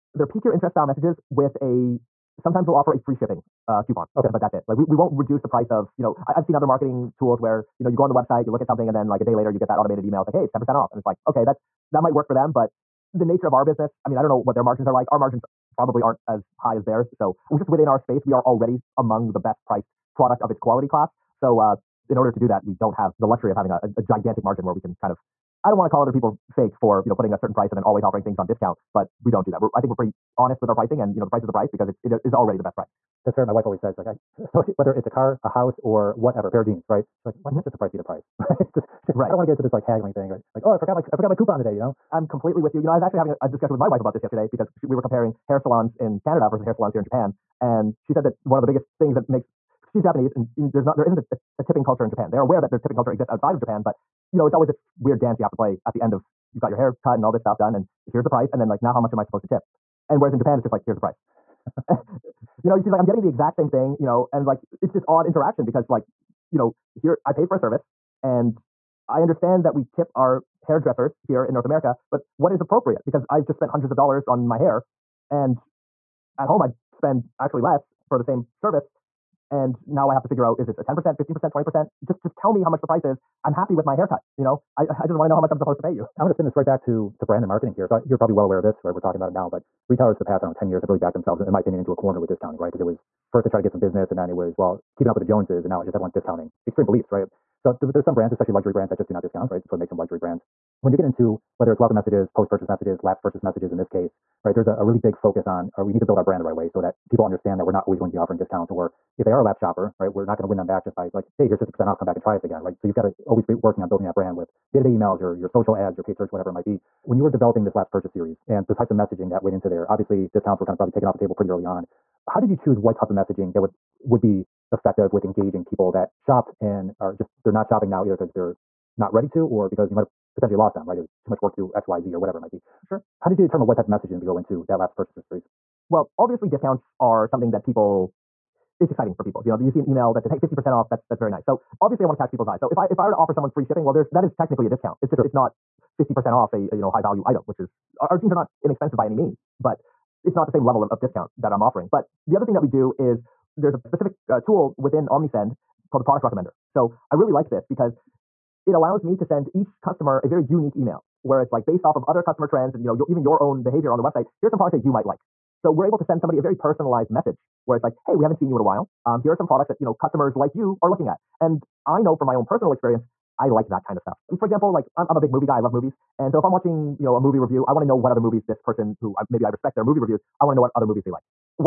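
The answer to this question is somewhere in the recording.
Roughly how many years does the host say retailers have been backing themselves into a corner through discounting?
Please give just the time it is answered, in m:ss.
1:30.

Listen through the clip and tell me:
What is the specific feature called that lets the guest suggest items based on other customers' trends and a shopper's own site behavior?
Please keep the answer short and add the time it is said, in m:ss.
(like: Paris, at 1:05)
product recommender, at 2:36.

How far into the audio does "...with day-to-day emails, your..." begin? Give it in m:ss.
1:54.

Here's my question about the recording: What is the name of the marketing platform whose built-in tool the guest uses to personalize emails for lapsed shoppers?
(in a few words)
Omnisend.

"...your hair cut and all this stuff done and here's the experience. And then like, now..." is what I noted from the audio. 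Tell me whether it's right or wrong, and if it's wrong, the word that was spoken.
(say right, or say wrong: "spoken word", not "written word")
wrong: "price", not "experience".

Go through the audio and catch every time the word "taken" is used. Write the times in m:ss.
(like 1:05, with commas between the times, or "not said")
2:00.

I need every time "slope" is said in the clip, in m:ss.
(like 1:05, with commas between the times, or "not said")
not said.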